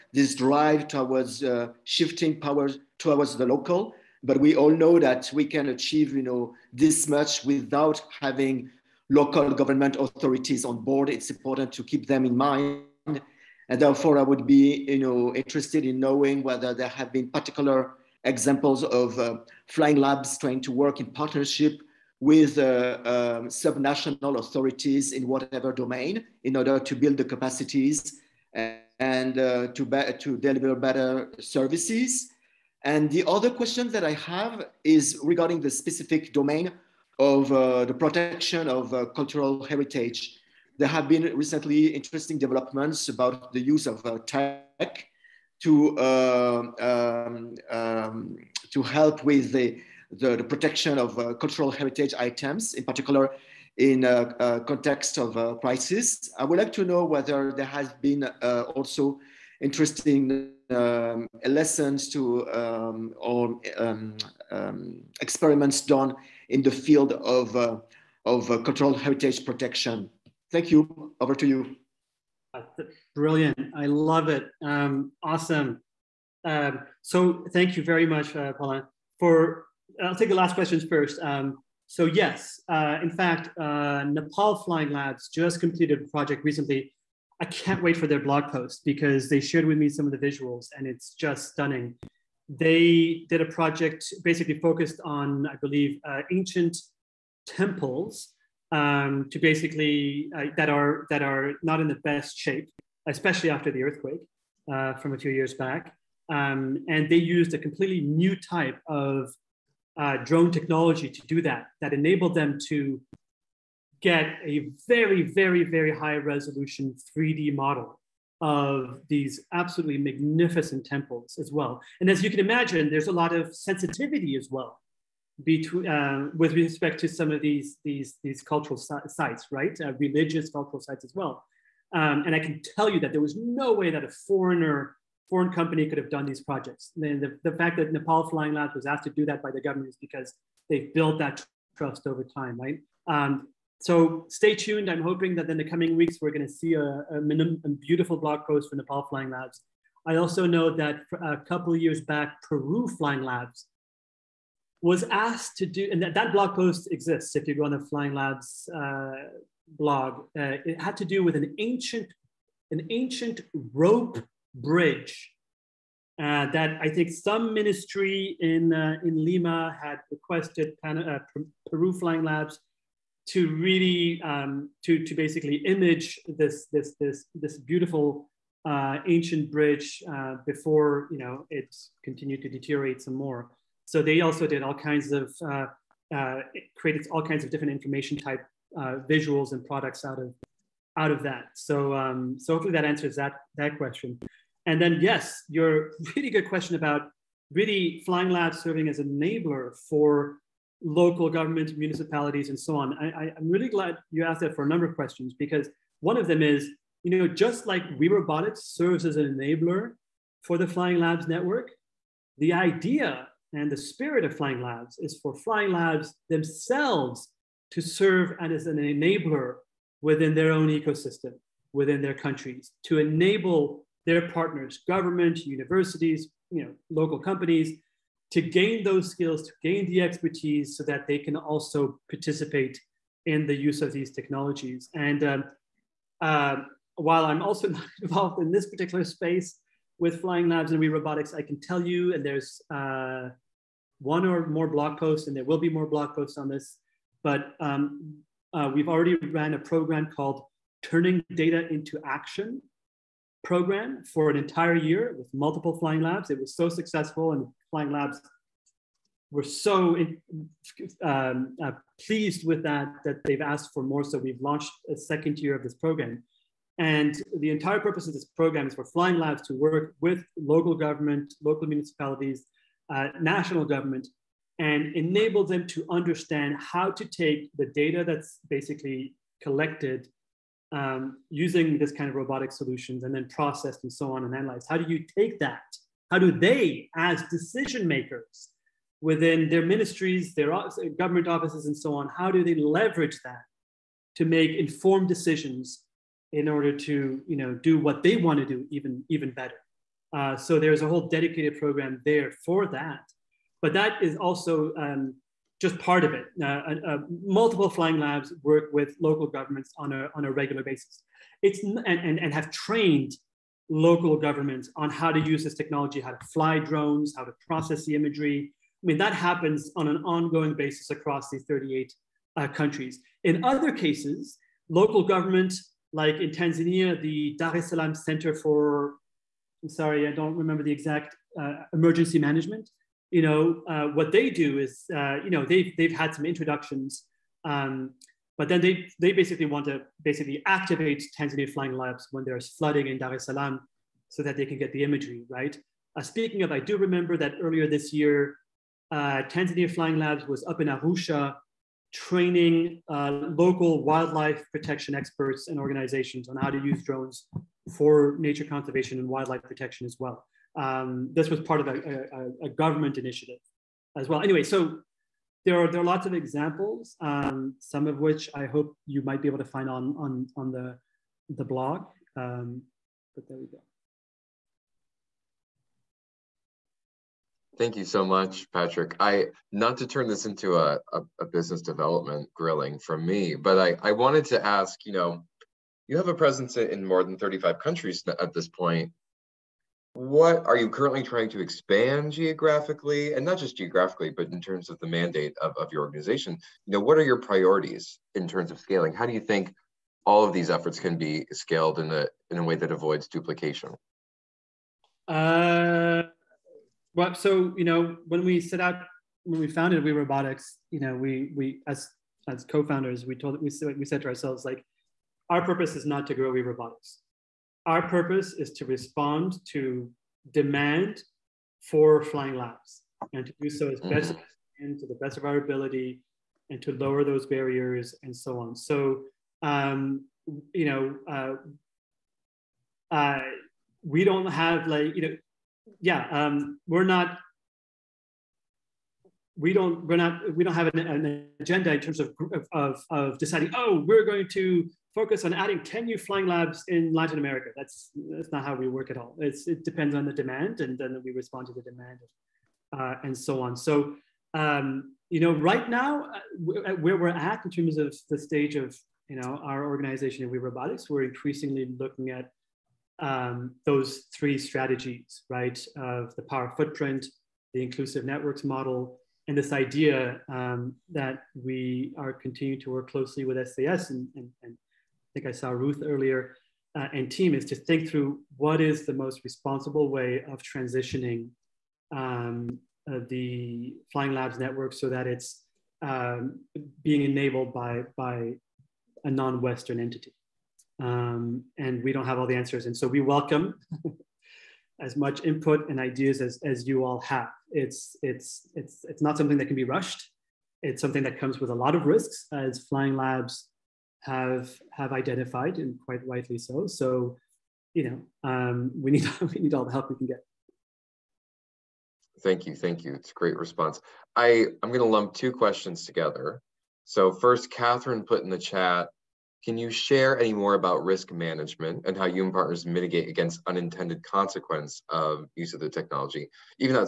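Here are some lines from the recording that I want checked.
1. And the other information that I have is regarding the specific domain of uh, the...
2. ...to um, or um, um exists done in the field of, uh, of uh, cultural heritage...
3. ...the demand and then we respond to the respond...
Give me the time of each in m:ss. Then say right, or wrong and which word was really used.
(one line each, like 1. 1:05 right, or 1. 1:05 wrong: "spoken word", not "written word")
1. 0:32 wrong: "question", not "information"
2. 1:02 wrong: "experiments", not "exists"
3. 7:30 wrong: "demand", not "respond".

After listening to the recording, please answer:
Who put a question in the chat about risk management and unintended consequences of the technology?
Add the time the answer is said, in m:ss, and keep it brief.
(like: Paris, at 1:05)
Catherine, at 8:37.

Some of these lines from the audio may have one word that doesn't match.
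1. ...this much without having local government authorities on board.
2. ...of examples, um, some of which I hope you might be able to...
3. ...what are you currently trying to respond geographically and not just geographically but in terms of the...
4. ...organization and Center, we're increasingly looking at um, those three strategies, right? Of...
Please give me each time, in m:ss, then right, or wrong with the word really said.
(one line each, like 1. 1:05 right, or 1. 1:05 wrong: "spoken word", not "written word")
1. 0:06 right
2. 6:06 right
3. 6:29 wrong: "expand", not "respond"
4. 7:39 wrong: "WeRobotics", not "Center".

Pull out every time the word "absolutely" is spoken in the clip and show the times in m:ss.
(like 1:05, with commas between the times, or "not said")
1:59.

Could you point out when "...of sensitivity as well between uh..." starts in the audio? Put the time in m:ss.
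2:03.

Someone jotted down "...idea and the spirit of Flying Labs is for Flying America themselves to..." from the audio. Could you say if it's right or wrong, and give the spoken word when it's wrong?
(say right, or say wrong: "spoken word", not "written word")
wrong: "Labs", not "America".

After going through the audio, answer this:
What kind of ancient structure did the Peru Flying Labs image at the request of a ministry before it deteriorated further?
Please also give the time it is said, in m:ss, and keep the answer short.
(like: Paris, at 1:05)
Rope bridge, at 2:43.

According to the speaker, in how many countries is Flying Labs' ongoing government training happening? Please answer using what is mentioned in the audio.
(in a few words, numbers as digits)
38.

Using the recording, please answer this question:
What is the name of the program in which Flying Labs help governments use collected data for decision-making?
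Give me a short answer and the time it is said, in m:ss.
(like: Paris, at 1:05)
Turning Data into Action, at 4:10.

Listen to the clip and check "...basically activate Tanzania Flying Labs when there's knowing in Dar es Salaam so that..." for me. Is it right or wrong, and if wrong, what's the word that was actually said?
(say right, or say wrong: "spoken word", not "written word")
wrong: "flooding", not "knowing".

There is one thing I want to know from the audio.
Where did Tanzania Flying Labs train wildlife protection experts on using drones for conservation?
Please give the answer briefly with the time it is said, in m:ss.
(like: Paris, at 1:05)
Arusha, at 5:50.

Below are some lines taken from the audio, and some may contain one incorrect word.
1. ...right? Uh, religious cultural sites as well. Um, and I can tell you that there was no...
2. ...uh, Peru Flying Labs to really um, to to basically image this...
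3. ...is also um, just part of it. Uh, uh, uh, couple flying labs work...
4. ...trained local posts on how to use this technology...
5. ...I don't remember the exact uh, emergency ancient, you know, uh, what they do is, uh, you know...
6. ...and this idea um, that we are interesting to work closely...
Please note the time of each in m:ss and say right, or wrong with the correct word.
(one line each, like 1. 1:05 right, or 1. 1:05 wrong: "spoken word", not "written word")
1. 2:09 right
2. 2:50 right
3. 5:04 wrong: "multiple", not "couple"
4. 5:12 wrong: "governments", not "posts"
5. 5:30 wrong: "management", not "ancient"
6. 7:49 wrong: "continuing", not "interesting".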